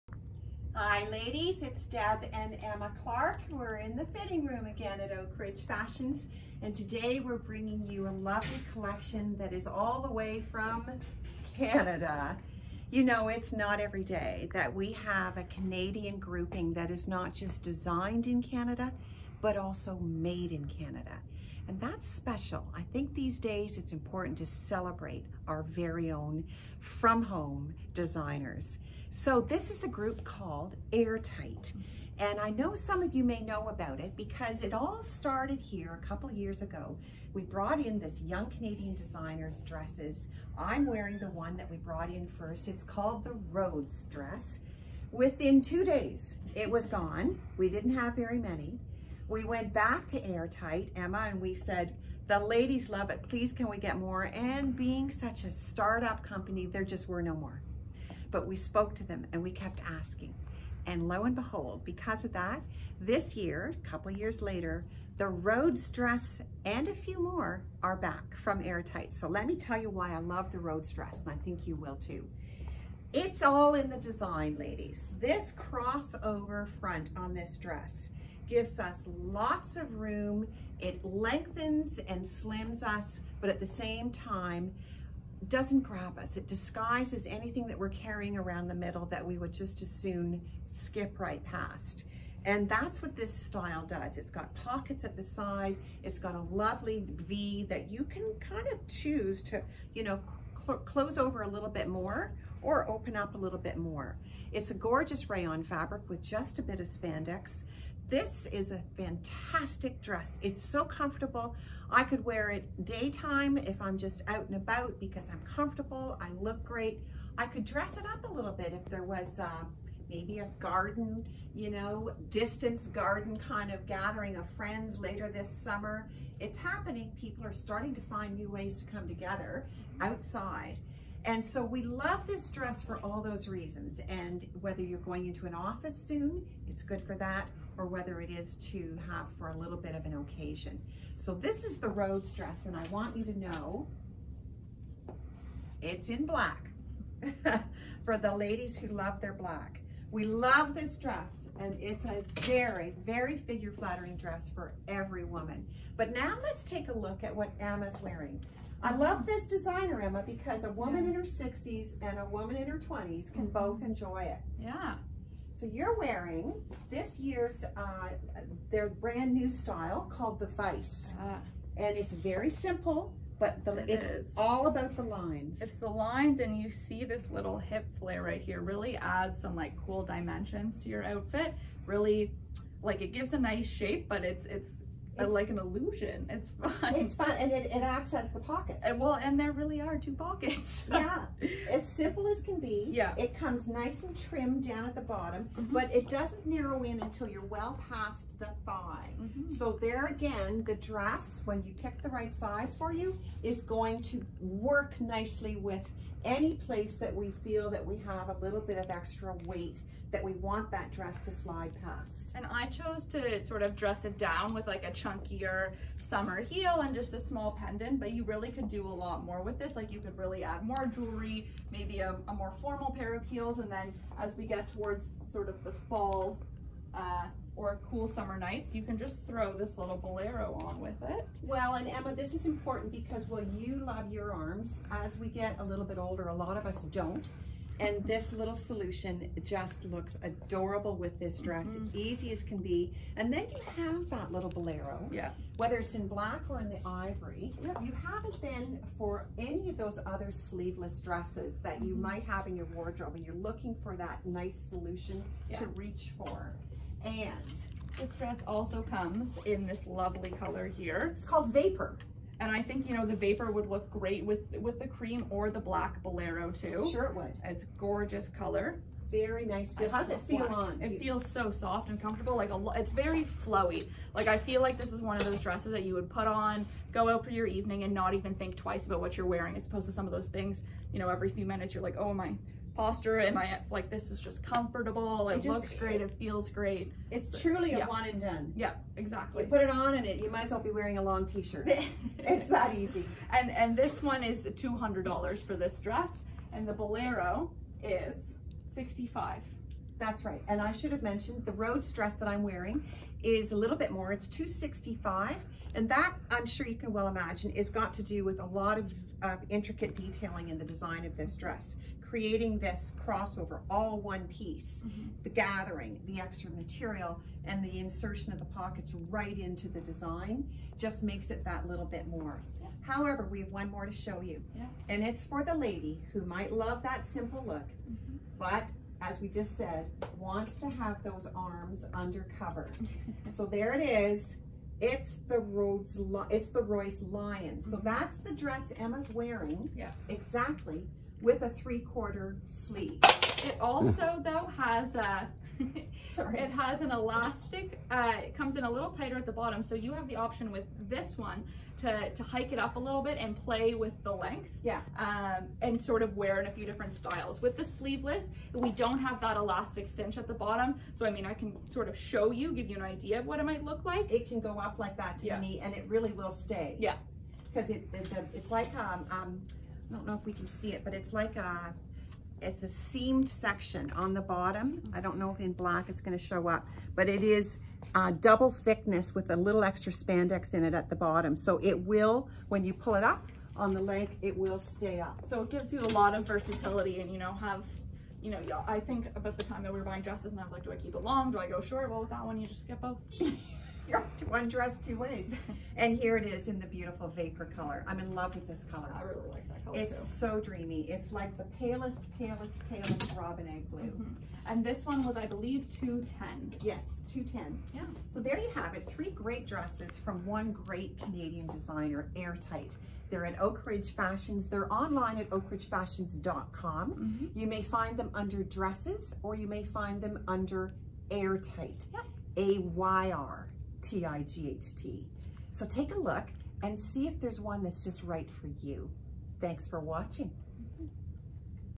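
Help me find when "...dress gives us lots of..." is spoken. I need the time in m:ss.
1:17.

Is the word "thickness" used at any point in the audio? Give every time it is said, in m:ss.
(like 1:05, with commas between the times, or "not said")
6:18.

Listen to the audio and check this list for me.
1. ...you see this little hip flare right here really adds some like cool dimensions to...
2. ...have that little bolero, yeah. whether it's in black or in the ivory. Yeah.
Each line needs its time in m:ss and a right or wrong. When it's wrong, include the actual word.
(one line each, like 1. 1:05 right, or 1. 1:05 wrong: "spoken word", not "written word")
1. 2:56 right
2. 4:03 right.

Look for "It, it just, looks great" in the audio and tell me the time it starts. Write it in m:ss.
4:45.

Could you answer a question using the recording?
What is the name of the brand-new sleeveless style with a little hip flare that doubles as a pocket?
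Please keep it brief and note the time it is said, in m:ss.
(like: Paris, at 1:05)
Vice, at 2:50.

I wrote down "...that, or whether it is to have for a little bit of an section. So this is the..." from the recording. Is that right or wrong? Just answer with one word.
wrong.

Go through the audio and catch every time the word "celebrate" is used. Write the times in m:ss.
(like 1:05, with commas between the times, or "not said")
0:24.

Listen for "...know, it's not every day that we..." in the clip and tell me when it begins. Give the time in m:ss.
0:13.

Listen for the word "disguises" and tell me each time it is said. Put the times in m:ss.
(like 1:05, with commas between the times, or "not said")
1:26.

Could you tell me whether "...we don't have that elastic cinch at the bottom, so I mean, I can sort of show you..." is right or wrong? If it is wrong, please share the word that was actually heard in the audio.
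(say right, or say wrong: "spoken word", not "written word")
right.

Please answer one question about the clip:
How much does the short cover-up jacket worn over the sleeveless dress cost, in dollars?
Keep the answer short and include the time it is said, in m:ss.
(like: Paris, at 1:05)
65, at 4:58.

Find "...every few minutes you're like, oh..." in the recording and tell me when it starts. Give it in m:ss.
4:41.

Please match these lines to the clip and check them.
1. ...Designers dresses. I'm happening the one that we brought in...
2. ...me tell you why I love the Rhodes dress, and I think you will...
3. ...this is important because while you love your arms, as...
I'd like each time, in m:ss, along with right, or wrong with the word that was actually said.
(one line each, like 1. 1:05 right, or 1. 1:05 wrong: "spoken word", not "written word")
1. 0:38 wrong: "wearing", not "happening"
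2. 1:09 right
3. 3:52 right.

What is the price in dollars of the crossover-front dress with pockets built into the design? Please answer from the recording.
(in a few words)
265.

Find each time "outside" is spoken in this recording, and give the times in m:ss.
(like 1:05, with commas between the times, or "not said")
2:10.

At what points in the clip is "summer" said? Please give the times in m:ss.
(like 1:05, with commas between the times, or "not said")
2:05, 3:35, 3:48.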